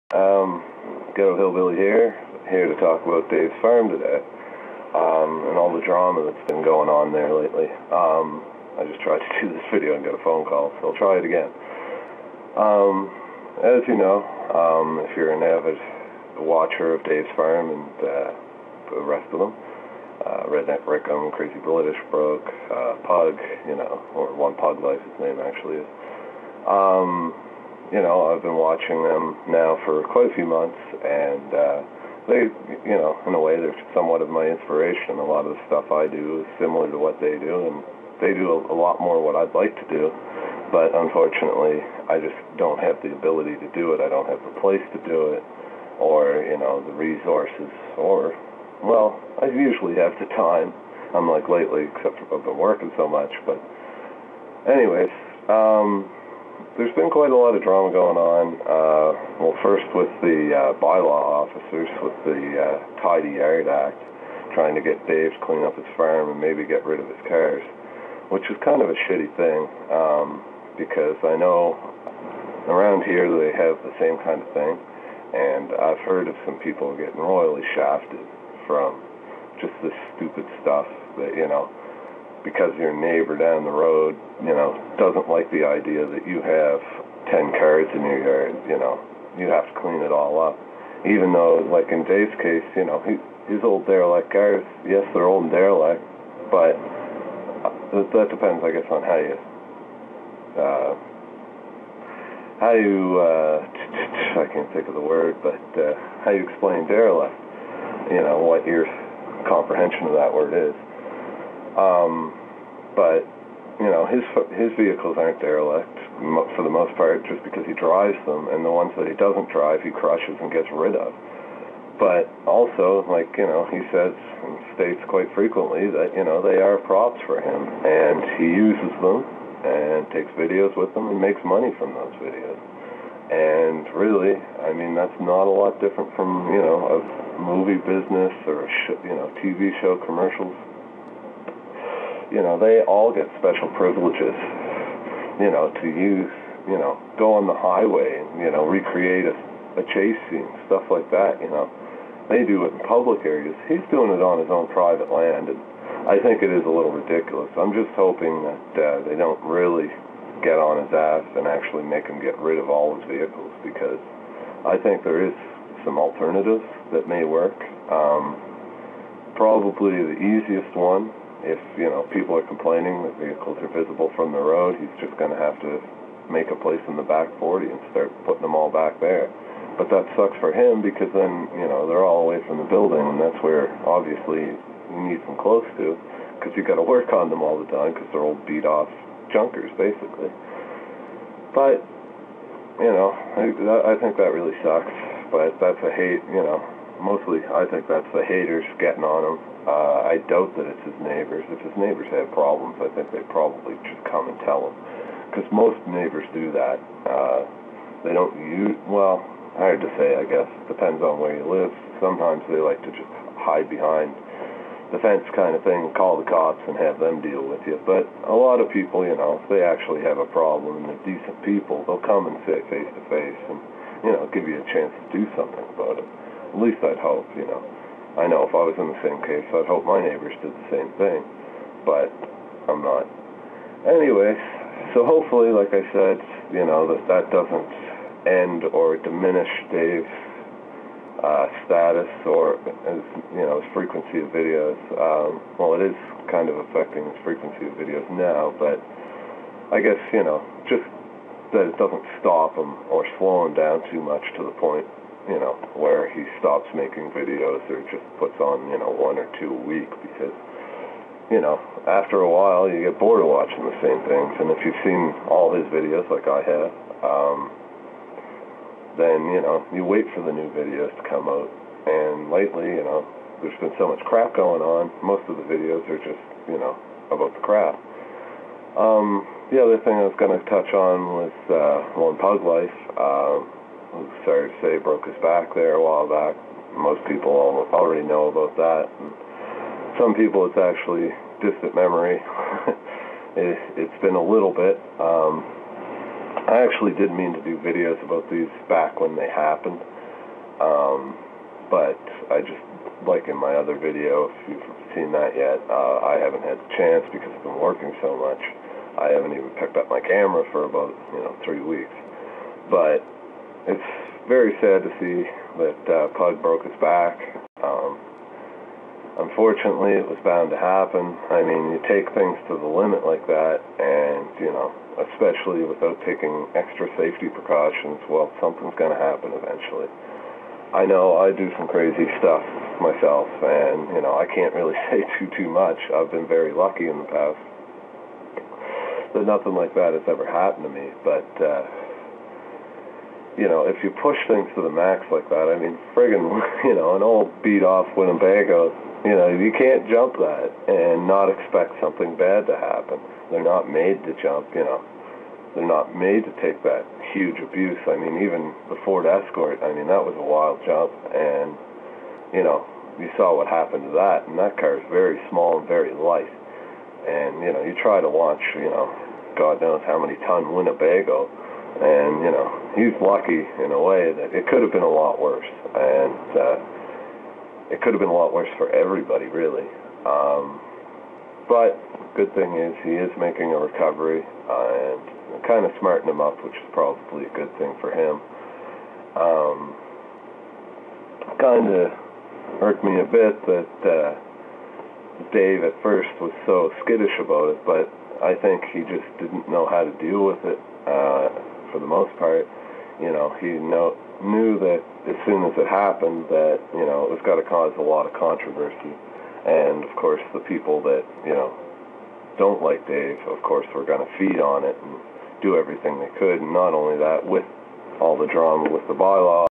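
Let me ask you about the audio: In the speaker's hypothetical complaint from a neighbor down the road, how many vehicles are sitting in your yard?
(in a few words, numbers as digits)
10.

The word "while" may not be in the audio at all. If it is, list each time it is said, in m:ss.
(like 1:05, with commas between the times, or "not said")
4:22, 4:45.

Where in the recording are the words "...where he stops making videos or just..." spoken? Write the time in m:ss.
4:15.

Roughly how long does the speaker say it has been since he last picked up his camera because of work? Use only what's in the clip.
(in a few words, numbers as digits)
three weeks.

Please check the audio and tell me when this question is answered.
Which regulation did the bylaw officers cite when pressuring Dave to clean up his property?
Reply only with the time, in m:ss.
1:03.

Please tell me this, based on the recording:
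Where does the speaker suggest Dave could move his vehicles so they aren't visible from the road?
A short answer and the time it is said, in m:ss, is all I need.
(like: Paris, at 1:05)
the back 40, at 2:56.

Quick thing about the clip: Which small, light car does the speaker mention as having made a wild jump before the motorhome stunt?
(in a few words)
Ford Escort.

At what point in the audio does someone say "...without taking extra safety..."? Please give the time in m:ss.
5:25.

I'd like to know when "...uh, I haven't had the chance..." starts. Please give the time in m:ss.
5:05.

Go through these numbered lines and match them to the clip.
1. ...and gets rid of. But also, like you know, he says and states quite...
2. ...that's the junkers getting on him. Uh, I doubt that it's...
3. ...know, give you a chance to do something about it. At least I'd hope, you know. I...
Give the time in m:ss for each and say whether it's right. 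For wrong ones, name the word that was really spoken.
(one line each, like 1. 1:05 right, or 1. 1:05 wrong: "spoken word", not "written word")
1. 2:00 right
2. 3:17 wrong: "haters", not "junkers"
3. 3:44 right.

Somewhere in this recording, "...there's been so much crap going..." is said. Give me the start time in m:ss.
4:33.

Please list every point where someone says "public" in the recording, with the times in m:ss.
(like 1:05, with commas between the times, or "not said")
2:32.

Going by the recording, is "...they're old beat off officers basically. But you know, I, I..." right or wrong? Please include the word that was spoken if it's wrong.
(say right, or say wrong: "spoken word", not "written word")
wrong: "junkers", not "officers".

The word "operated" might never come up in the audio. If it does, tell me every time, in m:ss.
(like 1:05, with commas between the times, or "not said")
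not said.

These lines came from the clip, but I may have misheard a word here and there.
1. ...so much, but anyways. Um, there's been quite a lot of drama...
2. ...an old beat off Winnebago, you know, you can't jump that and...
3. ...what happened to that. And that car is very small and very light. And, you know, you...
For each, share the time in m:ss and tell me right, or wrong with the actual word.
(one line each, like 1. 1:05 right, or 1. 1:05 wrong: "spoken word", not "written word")
1. 0:52 right
2. 5:46 right
3. 6:03 right.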